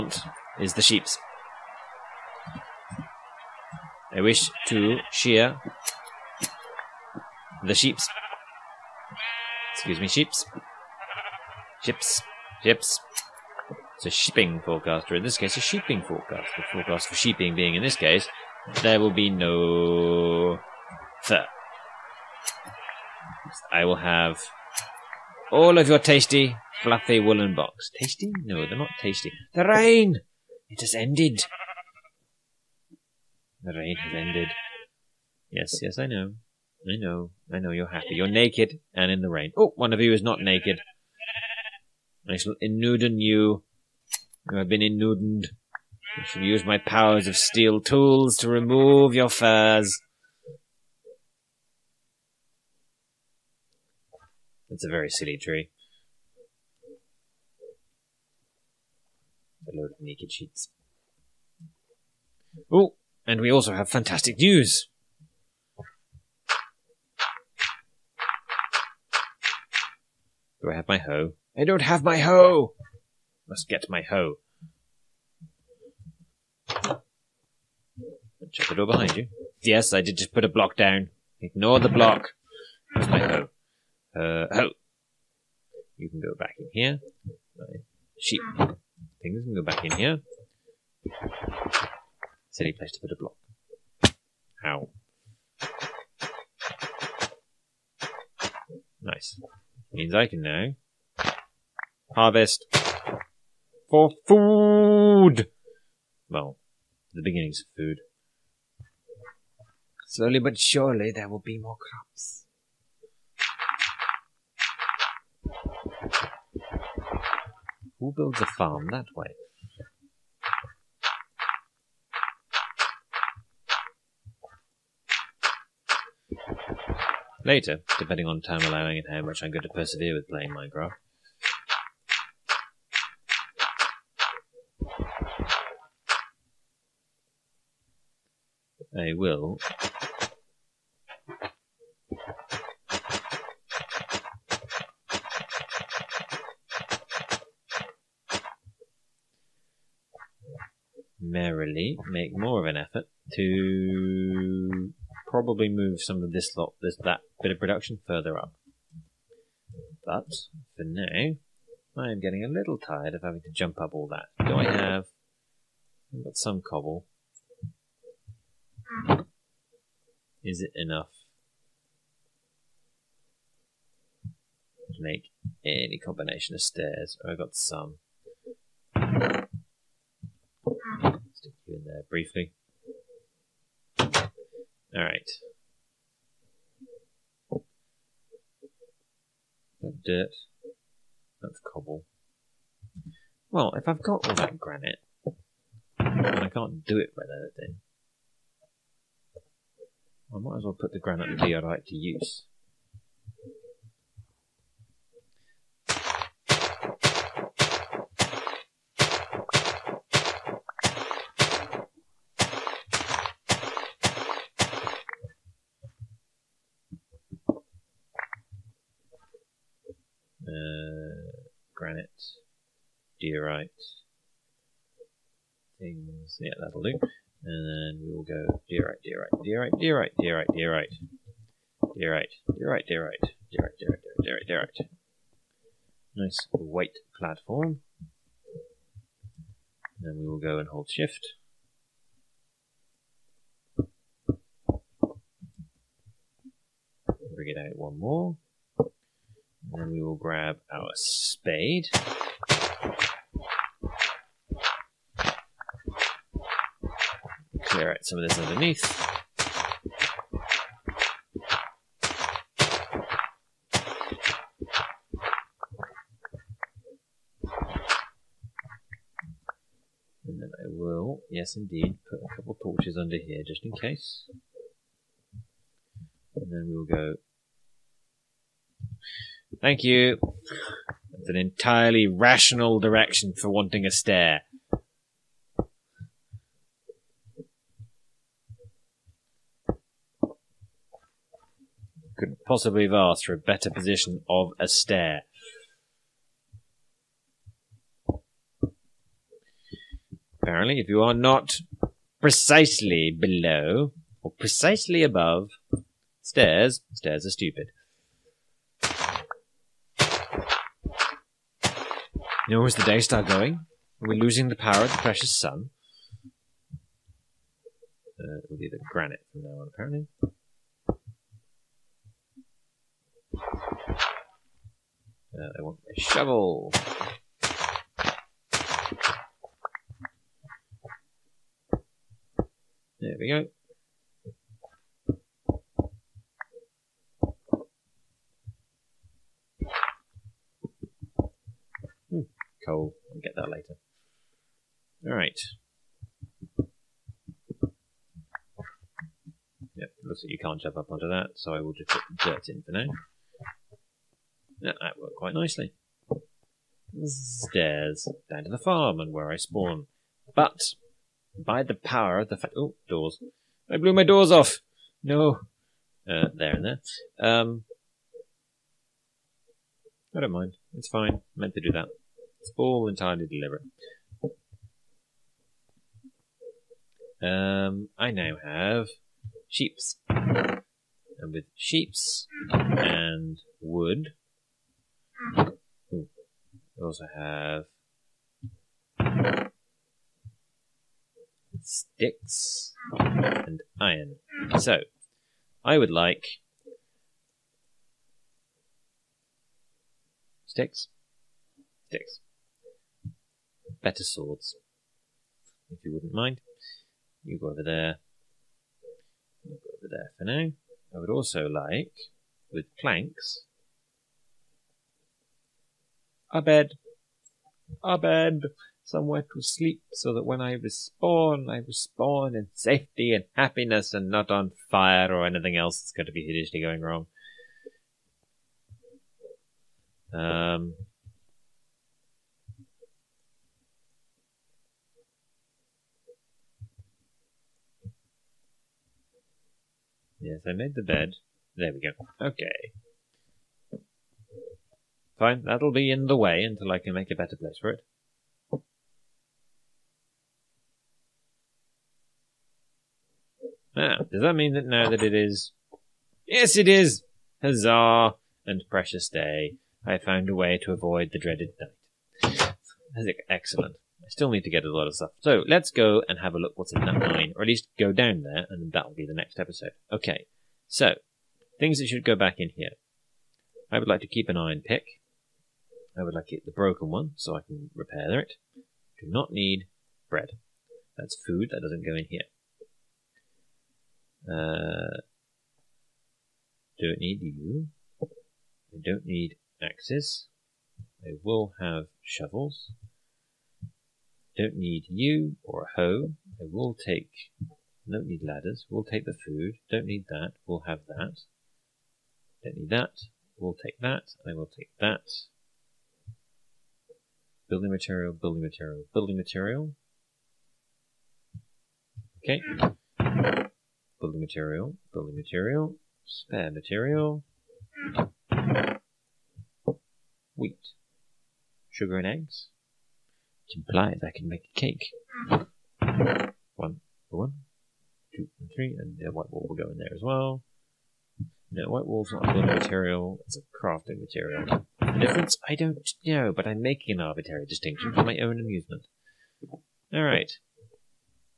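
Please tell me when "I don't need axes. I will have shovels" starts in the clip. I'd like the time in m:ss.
8:08.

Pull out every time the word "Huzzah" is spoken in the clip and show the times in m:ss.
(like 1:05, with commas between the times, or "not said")
7:37.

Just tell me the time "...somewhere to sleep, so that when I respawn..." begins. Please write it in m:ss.
6:58.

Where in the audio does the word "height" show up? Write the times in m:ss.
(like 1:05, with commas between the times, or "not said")
not said.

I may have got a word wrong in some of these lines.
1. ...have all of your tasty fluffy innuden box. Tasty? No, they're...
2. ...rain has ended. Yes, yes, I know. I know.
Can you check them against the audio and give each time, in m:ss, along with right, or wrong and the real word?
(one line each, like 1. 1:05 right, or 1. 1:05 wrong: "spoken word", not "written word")
1. 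0:23 wrong: "woolen", not "innuden"
2. 0:33 right.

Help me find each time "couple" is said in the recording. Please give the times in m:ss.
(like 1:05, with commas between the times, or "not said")
4:32.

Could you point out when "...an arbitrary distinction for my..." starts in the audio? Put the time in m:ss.
8:56.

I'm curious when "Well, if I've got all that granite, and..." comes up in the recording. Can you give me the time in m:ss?
3:13.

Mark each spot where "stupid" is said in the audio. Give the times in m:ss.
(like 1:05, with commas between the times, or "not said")
5:07.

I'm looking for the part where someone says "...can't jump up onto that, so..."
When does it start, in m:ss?
5:50.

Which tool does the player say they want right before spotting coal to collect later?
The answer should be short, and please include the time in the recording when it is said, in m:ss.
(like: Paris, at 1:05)
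Shovel, at 5:25.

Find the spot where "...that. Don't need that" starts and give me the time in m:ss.
8:20.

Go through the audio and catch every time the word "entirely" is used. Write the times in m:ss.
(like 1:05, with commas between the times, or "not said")
4:41, 6:12.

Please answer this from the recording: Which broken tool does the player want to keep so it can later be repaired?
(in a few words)
Iron pick.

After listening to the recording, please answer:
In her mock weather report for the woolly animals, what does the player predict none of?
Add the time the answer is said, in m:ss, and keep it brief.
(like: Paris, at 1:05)
Fur, at 0:19.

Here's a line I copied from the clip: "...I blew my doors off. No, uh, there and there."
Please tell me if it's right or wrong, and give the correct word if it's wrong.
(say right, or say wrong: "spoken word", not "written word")
right.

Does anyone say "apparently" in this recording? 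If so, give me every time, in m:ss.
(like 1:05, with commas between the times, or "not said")
5:00, 5:19.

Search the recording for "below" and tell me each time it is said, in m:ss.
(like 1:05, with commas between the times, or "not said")
5:03.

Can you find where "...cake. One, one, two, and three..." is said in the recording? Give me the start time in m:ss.
8:44.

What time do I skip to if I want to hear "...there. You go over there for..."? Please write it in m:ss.
6:47.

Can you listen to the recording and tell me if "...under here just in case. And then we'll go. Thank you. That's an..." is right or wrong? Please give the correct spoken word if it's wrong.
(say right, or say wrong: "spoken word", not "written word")
right.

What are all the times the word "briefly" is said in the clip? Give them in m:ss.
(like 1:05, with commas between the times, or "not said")
3:02.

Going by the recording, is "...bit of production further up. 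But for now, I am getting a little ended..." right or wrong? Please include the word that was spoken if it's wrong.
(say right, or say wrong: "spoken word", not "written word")
wrong: "tired", not "ended".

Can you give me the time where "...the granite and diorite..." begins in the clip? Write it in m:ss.
3:20.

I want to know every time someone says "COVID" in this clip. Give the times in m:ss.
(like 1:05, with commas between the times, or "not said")
not said.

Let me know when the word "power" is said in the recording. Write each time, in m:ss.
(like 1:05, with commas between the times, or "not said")
0:46, 5:14, 6:01.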